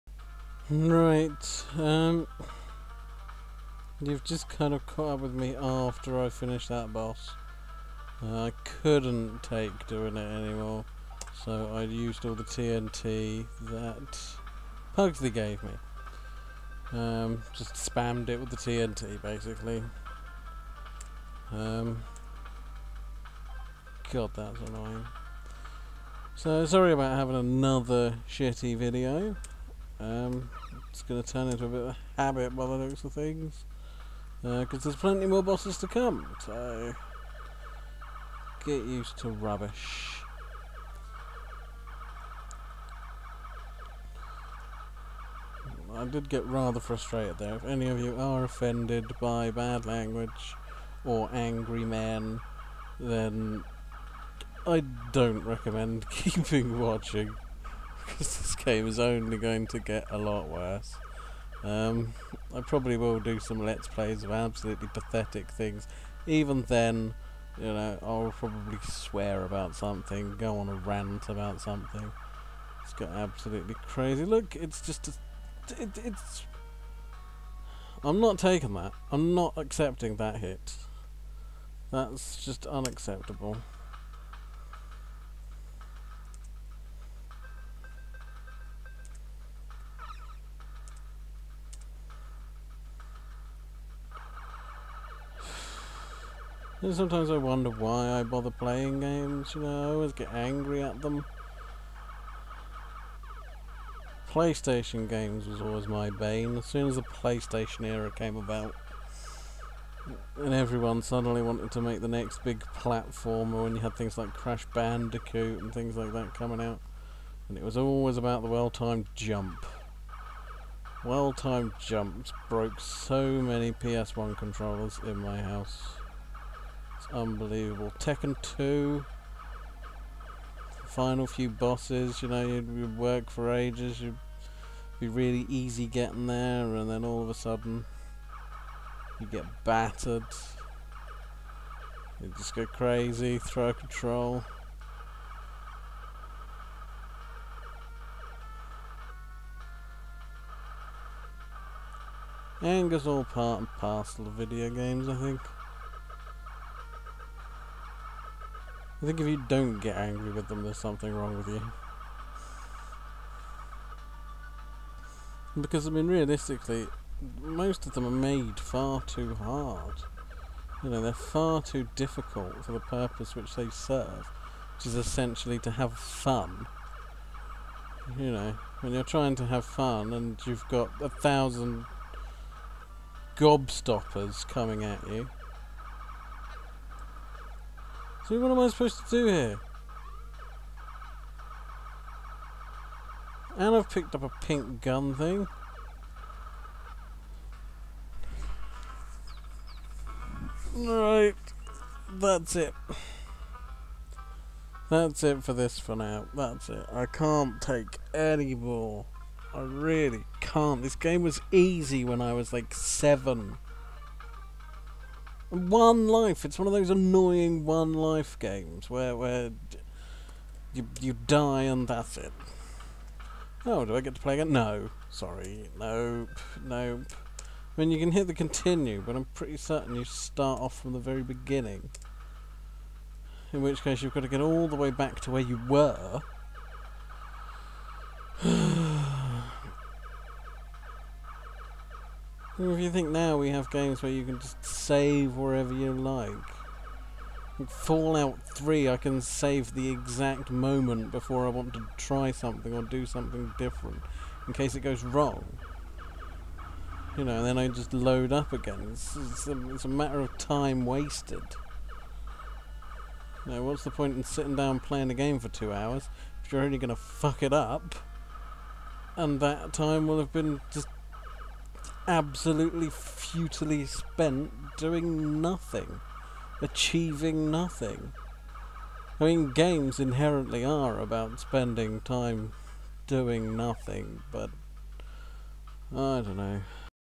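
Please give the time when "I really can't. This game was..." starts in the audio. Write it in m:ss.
3:29.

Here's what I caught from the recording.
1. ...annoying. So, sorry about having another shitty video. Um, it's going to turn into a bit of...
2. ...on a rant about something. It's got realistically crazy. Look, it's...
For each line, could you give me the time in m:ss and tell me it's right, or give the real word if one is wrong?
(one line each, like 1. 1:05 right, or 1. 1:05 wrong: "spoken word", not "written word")
1. 0:24 right
2. 1:10 wrong: "absolutely", not "realistically".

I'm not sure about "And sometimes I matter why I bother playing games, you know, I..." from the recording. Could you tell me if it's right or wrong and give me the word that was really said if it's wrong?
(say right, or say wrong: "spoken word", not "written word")
wrong: "wonder", not "matter".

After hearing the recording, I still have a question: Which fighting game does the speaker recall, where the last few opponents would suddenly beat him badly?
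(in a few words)
Tekken 2.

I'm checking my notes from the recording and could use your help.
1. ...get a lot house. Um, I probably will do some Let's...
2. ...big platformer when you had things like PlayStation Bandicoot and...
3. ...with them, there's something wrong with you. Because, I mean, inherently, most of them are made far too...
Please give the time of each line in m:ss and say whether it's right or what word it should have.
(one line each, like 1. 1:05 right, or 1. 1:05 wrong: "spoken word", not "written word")
1. 0:59 wrong: "worse", not "house"
2. 1:52 wrong: "Crash", not "PlayStation"
3. 2:40 wrong: "realistically", not "inherently".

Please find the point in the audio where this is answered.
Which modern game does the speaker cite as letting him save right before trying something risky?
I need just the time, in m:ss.
4:07.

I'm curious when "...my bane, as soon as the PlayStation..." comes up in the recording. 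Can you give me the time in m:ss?
1:45.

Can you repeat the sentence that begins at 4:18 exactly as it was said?
It's, it's, a, it's a matter of time wasted.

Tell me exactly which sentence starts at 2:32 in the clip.
Anger's all part and parcel of video games, I think.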